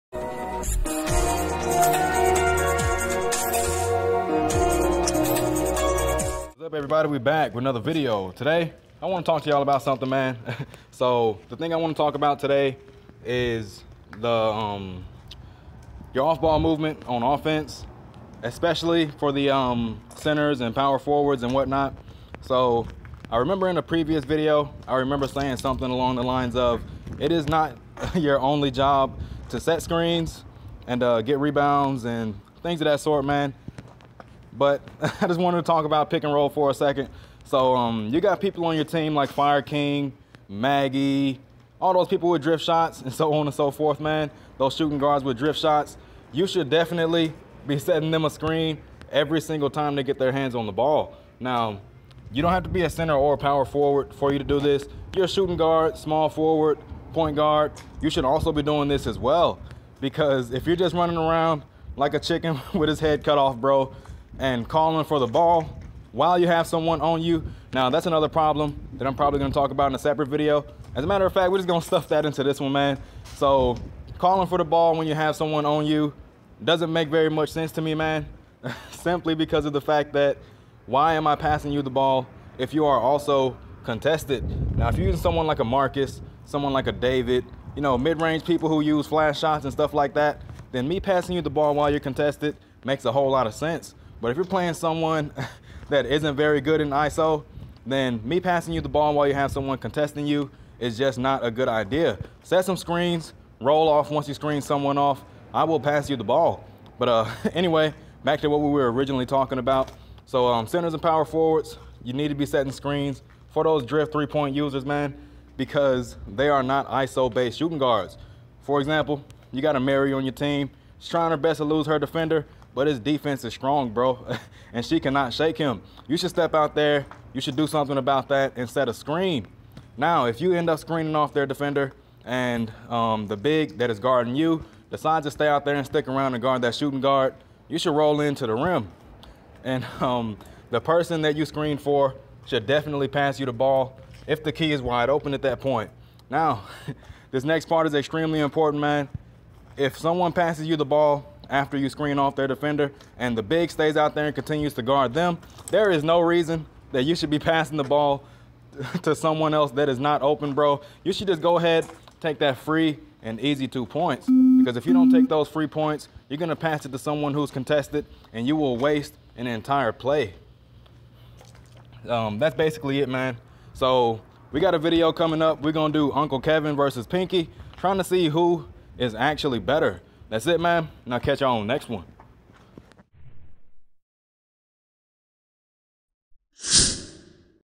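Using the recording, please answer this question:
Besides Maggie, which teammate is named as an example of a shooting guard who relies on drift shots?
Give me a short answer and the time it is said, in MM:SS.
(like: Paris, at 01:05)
Fire King, at 00:39.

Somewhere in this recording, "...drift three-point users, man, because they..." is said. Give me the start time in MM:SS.
01:53.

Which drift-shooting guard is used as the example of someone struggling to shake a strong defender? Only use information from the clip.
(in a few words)
Mary.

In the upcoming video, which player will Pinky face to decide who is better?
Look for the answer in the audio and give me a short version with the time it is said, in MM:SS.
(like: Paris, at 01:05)
Uncle Kevin, at 02:56.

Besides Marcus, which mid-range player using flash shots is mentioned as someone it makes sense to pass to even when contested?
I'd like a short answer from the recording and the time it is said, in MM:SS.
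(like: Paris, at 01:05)
David, at 01:26.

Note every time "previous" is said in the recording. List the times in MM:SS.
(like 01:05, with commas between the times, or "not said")
00:23.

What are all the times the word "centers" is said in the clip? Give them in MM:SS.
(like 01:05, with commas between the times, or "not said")
00:20, 00:52, 01:50.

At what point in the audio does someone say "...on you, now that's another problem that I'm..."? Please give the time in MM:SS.
01:06.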